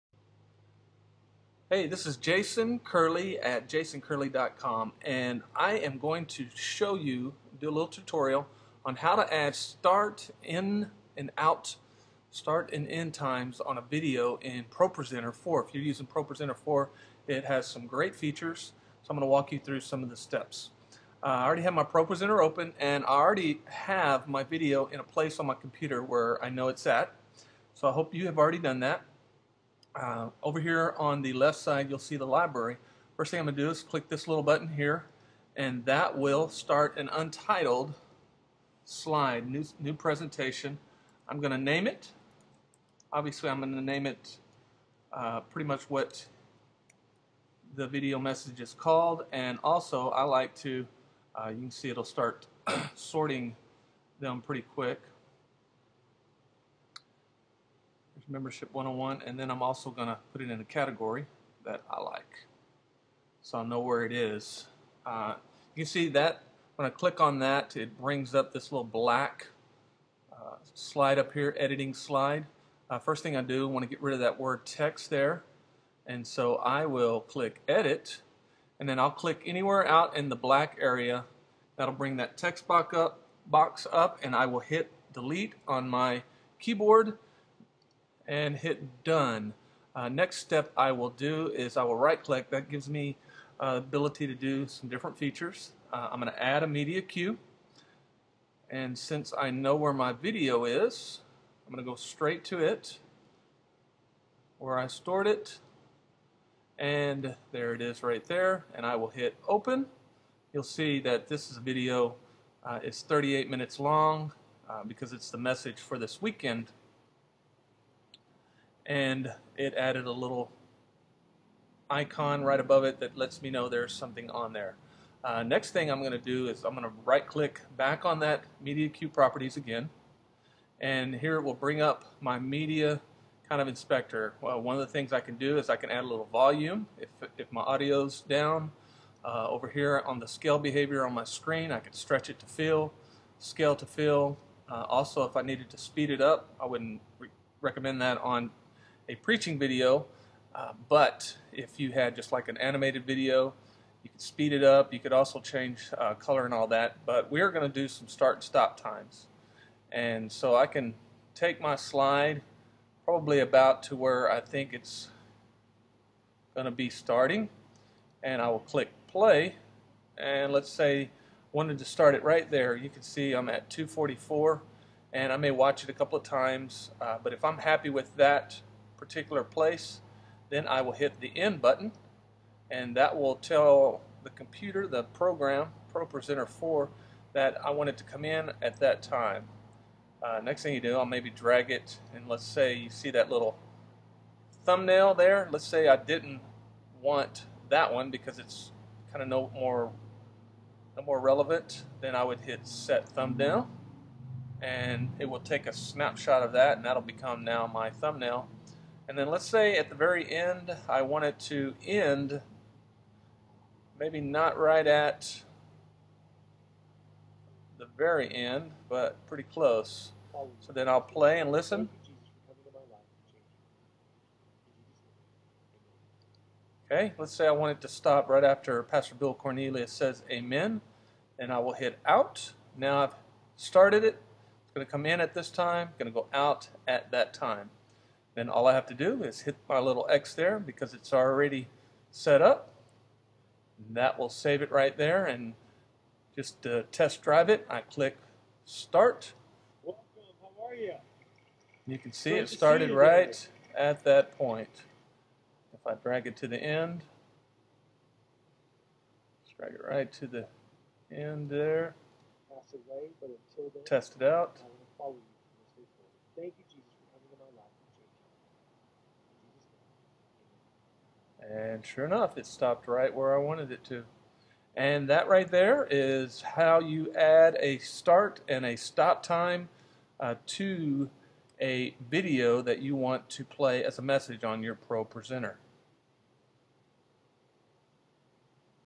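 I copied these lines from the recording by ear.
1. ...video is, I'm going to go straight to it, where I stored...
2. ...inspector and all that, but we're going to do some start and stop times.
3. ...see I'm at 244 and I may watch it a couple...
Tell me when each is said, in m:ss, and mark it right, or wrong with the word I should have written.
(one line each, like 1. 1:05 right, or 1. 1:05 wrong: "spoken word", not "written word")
1. 1:40 right
2. 2:36 wrong: "color", not "inspector"
3. 2:53 right.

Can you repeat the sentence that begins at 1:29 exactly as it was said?
Uh, next step I will do is I will right click.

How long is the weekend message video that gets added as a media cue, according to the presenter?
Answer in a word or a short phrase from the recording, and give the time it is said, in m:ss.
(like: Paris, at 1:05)
38 minutes, at 1:53.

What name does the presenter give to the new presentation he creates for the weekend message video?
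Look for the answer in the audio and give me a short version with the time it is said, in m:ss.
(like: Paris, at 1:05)
Membership 101, at 0:58.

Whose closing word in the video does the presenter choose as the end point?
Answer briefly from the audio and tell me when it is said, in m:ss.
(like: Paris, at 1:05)
Pastor Bill Cornelius, at 3:48.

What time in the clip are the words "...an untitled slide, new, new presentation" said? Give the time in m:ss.
0:36.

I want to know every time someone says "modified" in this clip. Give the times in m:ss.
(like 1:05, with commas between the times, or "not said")
not said.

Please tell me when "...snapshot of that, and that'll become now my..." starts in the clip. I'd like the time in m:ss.
3:25.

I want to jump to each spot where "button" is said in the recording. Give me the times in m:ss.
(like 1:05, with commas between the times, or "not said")
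0:34, 3:01.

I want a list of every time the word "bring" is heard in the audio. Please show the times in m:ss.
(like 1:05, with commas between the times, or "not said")
1:07, 1:21, 2:11.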